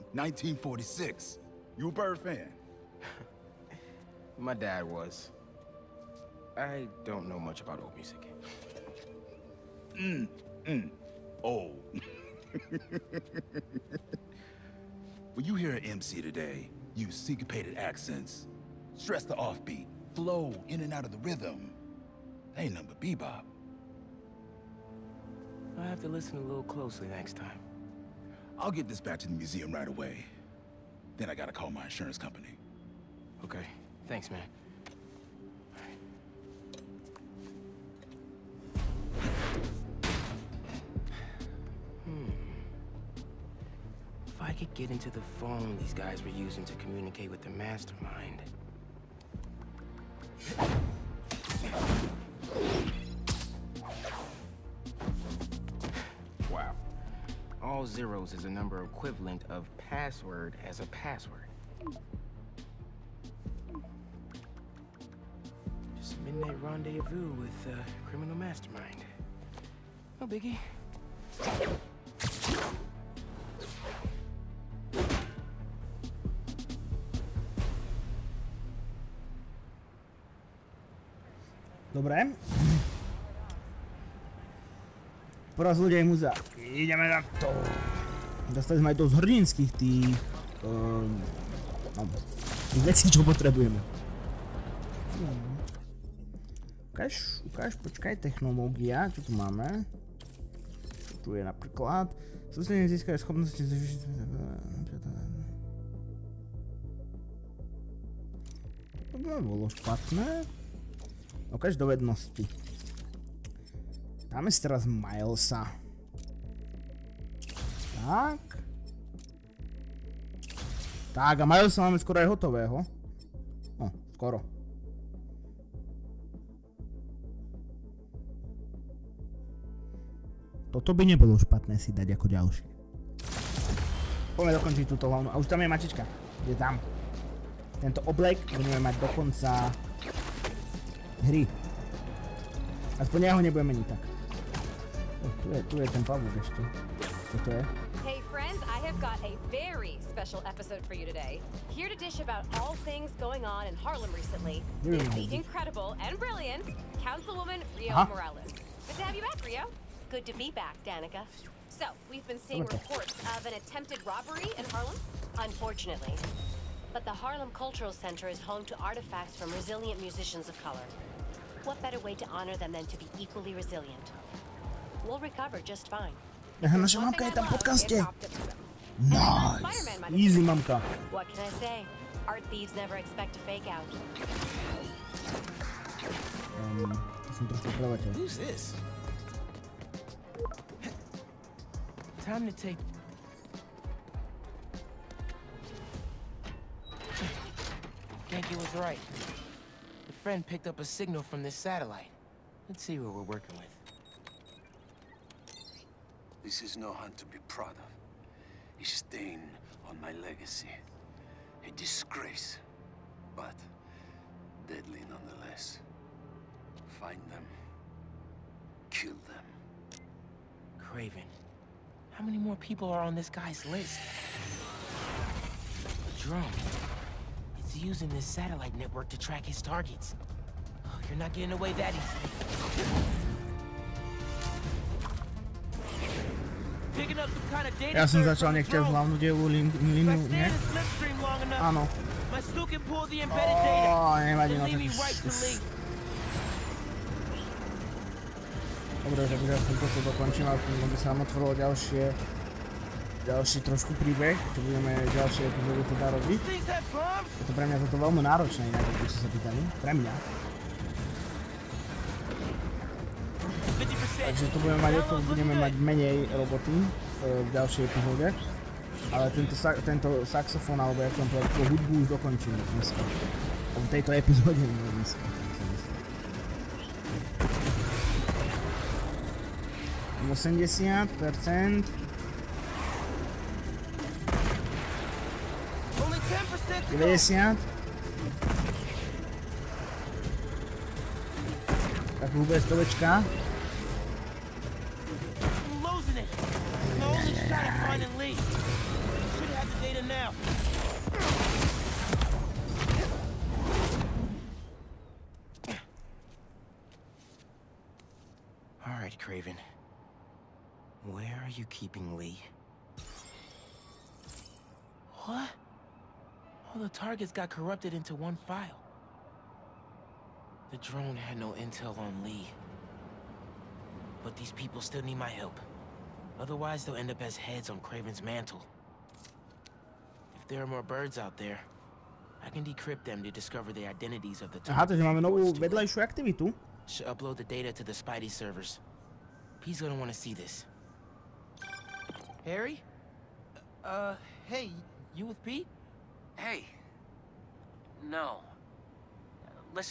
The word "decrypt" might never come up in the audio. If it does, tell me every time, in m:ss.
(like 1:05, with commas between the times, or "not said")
5:32.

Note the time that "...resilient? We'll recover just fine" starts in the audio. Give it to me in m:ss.
2:53.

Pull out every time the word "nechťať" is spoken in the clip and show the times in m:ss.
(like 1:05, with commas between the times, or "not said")
3:58.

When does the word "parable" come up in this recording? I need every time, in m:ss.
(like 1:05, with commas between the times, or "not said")
not said.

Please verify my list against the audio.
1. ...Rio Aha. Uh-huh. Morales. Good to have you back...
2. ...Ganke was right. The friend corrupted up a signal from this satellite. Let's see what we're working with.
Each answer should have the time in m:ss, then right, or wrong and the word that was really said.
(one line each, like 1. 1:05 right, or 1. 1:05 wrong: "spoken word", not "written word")
1. 2:37 right
2. 3:18 wrong: "picked", not "corrupted".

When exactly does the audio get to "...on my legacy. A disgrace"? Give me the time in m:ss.
3:29.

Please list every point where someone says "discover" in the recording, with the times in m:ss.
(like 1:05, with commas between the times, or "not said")
5:33.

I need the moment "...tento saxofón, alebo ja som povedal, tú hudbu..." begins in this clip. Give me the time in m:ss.
4:29.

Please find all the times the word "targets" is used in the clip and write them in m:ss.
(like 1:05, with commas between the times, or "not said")
3:49, 5:16, 5:34.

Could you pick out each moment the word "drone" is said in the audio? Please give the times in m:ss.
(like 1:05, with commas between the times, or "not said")
3:46, 5:20.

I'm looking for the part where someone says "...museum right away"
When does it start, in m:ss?
0:29.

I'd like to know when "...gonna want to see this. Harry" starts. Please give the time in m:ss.
5:39.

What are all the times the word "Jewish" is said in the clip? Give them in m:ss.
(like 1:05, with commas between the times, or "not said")
not said.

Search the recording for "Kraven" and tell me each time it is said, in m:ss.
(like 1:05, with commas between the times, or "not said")
3:40, 5:09, 5:27.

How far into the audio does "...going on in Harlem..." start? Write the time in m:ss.
2:33.